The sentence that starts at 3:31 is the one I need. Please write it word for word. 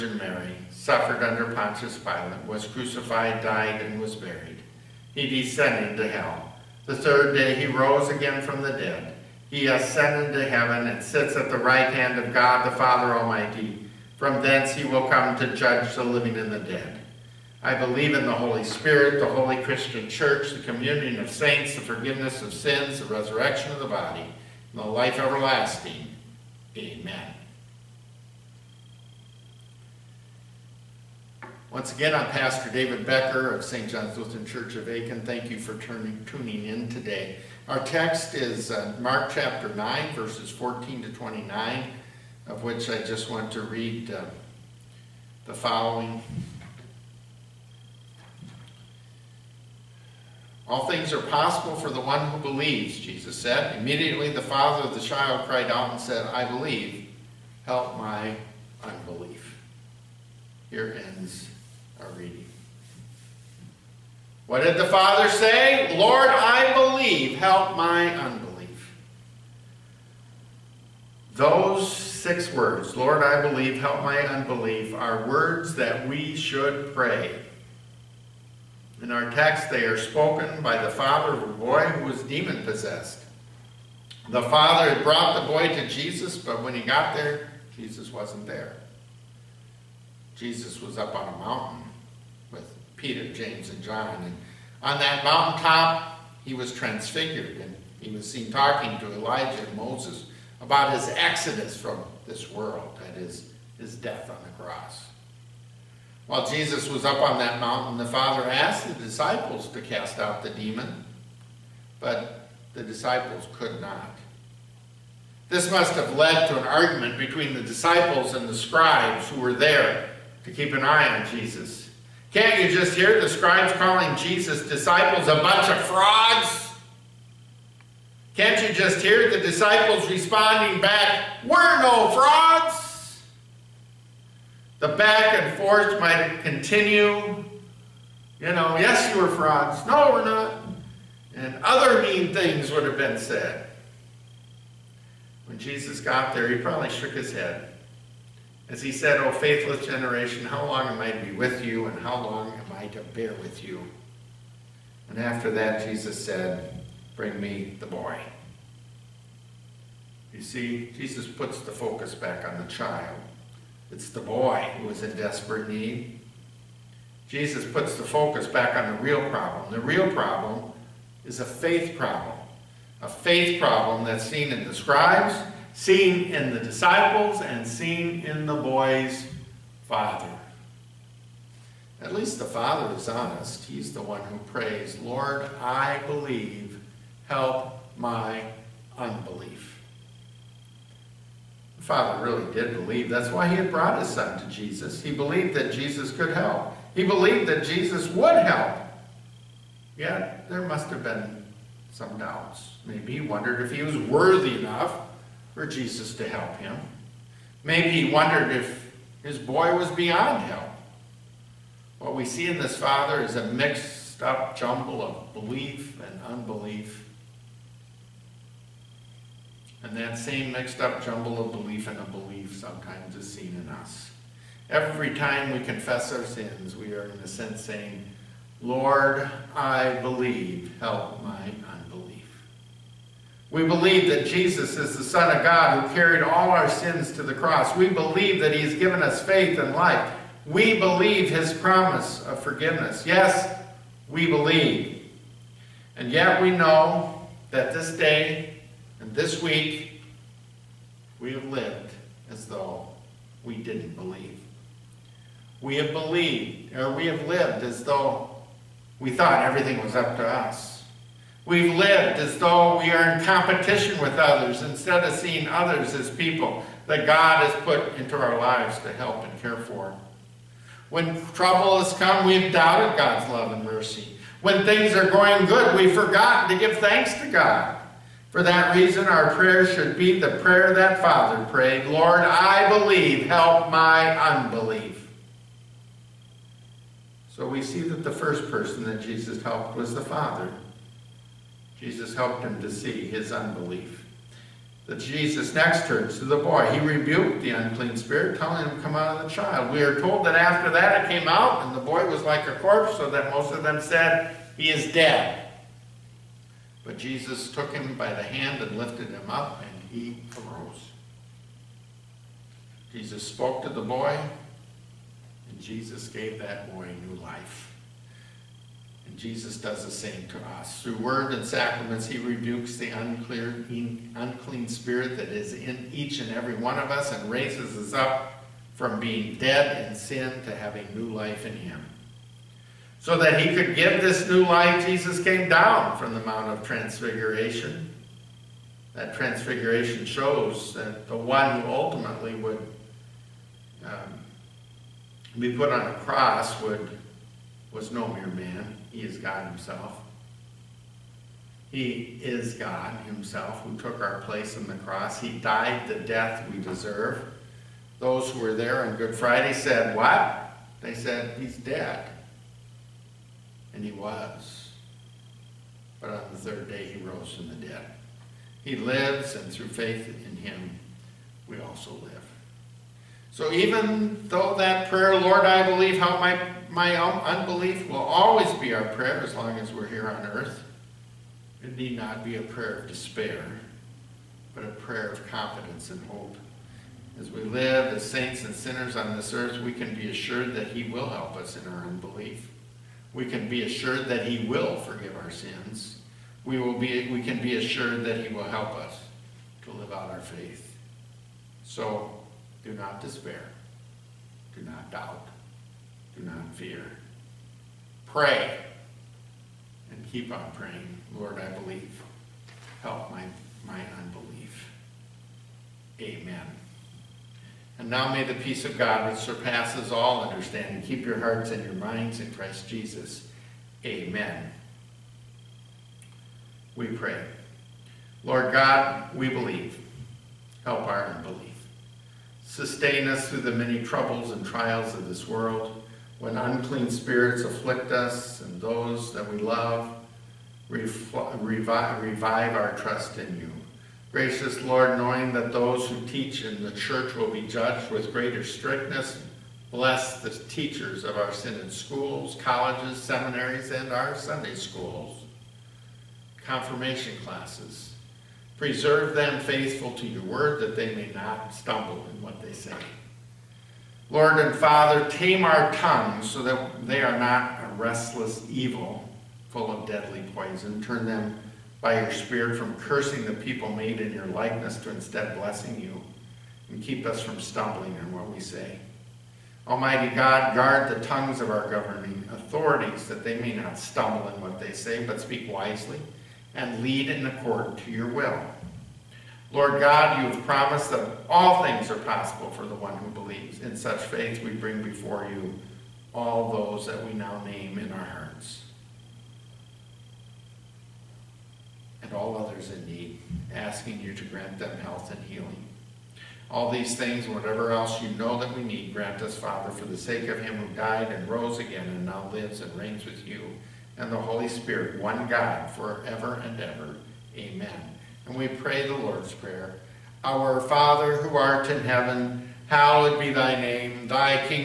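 What we see in this father is a mixed up jumble of belief and unbelief.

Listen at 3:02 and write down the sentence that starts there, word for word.
At least the father is honest.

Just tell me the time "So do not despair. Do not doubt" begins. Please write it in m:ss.
6:41.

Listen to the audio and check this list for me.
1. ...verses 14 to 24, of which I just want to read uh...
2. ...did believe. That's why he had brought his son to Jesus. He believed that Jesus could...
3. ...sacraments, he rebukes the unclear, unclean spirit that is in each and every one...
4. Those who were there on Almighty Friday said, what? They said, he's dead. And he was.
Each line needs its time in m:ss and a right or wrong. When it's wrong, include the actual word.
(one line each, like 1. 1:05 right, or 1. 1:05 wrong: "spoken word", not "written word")
1. 0:40 wrong: "29", not "24"
2. 3:12 right
3. 5:21 right
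4. 5:57 wrong: "Good", not "Almighty".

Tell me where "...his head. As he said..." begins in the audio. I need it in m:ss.
2:27.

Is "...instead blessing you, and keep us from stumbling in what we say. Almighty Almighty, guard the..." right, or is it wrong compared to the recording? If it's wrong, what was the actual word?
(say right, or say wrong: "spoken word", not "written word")
wrong: "God", not "Almighty".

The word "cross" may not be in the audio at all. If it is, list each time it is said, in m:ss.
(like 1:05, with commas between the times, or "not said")
1:44, 3:57, 5:45, 5:54.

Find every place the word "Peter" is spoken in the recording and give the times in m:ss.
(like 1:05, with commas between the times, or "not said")
1:32.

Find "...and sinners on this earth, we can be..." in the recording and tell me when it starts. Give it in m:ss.
6:28.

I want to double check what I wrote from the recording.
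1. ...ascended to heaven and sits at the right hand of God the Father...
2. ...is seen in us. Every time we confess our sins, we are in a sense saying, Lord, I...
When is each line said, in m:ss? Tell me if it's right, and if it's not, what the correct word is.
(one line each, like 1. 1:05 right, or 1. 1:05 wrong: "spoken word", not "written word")
1. 0:09 right
2. 3:43 right.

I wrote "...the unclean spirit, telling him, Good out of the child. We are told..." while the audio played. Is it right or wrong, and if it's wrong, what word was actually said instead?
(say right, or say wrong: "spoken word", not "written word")
wrong: "Come", not "Good".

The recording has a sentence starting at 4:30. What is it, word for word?
When trouble has come, we've doubted God's love and mercy.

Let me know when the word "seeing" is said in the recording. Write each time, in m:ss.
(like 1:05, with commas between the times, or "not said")
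4:25.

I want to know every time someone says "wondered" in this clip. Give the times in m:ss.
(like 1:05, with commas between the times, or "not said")
3:23, 3:28.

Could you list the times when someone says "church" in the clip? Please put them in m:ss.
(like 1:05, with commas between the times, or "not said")
0:20, 0:34, 7:26.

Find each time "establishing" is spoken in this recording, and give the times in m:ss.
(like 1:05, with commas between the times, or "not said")
not said.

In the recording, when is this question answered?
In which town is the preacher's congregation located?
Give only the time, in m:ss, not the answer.
0:34.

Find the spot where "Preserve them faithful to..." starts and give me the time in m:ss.
7:38.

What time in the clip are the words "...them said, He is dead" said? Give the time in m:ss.
5:03.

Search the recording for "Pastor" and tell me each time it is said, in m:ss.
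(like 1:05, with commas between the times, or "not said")
0:32.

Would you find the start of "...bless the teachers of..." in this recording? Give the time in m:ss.
7:29.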